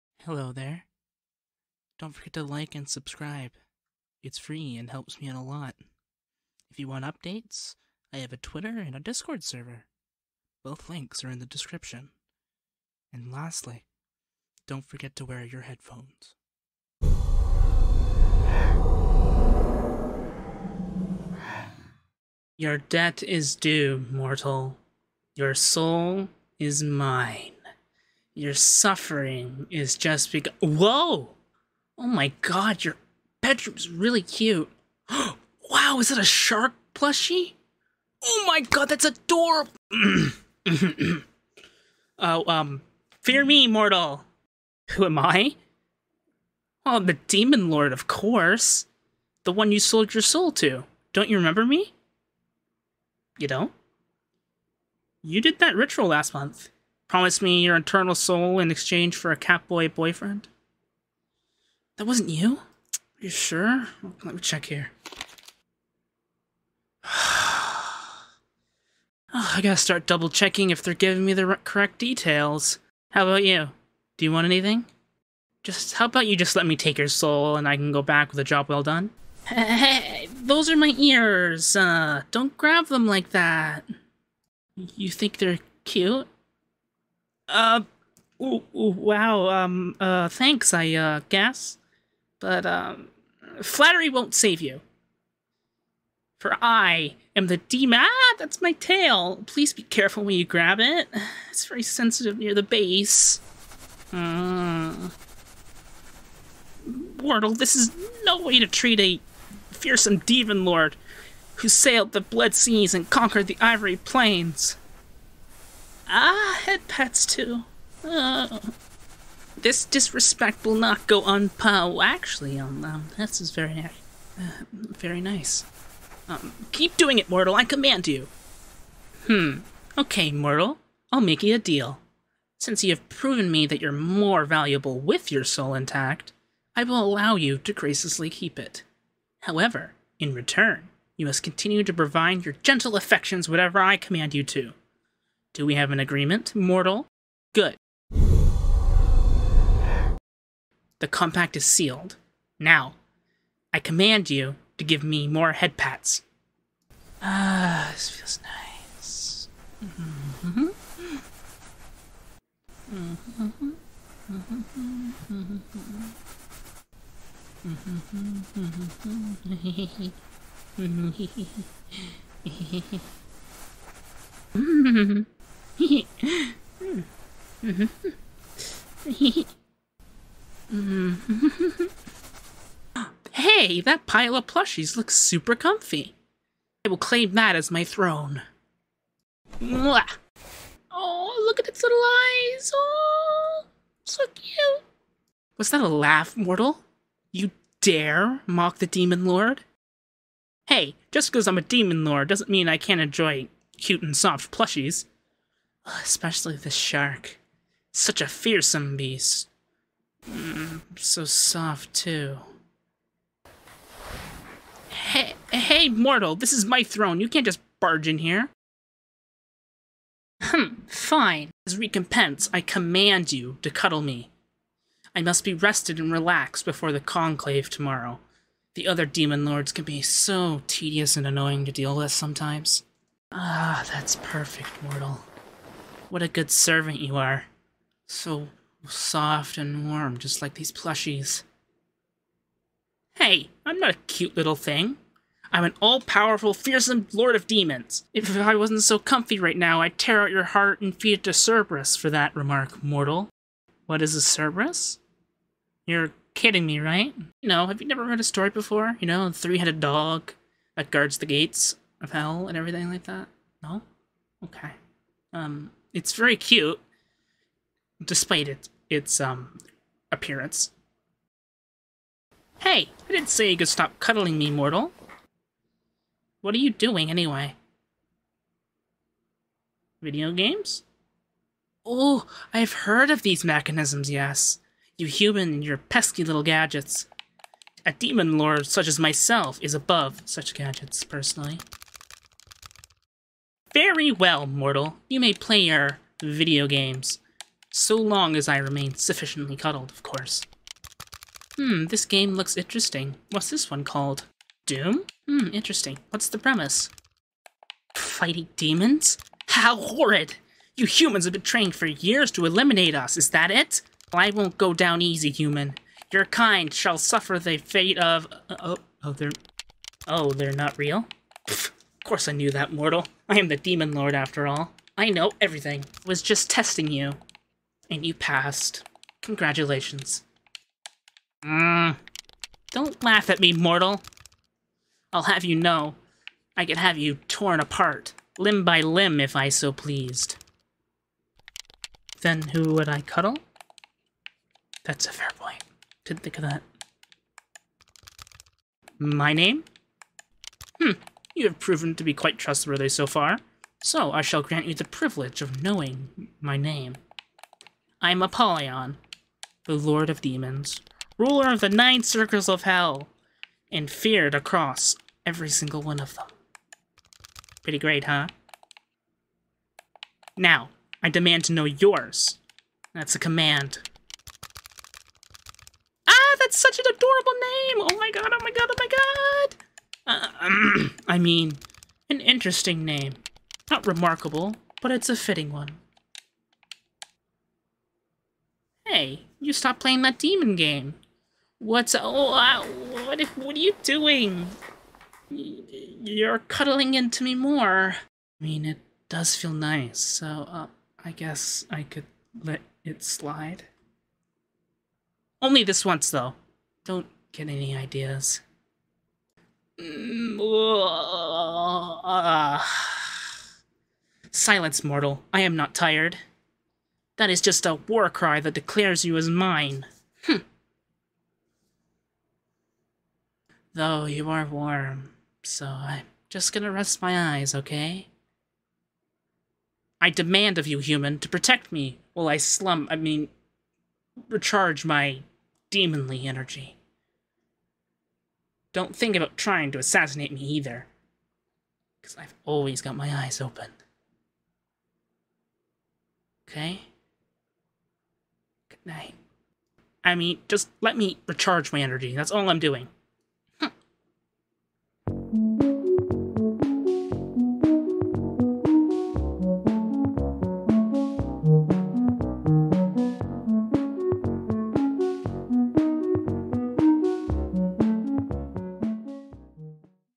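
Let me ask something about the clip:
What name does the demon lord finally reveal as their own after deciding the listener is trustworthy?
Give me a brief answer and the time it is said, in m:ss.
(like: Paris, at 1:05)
Apollyon, at 5:58.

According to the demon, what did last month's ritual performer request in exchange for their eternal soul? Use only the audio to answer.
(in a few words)
A catboy boyfriend.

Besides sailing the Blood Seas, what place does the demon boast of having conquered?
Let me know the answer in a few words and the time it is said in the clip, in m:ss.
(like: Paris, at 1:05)
The Ivory Plains, at 1:53.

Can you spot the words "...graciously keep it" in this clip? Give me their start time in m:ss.
2:17.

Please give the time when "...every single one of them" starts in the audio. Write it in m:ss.
6:05.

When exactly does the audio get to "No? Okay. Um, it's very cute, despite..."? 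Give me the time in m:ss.
4:23.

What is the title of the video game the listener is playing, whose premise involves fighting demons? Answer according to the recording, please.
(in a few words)
Doom.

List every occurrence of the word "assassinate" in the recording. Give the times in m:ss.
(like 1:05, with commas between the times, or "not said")
7:19.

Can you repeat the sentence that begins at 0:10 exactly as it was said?
Both links are in the description.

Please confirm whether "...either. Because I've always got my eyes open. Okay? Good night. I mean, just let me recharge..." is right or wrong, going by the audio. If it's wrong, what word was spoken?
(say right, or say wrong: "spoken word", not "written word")
right.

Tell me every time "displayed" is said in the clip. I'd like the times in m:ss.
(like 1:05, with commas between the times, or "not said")
not said.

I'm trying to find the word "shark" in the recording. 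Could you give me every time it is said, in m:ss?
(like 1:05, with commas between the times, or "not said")
0:36, 3:26.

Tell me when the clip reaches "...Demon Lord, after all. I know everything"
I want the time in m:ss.
5:23.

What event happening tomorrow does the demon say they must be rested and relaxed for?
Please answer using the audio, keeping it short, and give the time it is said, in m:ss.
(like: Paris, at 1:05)
The conclave, at 3:46.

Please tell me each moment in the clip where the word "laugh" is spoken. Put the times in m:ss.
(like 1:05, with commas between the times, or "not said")
3:15, 5:33.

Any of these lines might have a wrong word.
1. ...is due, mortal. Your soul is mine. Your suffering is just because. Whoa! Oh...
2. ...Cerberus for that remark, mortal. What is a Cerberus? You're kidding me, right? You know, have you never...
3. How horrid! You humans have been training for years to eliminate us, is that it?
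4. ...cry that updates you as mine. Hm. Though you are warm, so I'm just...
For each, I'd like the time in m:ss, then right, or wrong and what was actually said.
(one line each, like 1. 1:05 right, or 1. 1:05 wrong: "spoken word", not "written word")
1. 0:23 right
2. 4:11 right
3. 5:09 right
4. 6:58 wrong: "declares", not "updates".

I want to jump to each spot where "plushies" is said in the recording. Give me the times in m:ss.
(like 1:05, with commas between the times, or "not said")
0:36, 3:04, 3:24, 4:00.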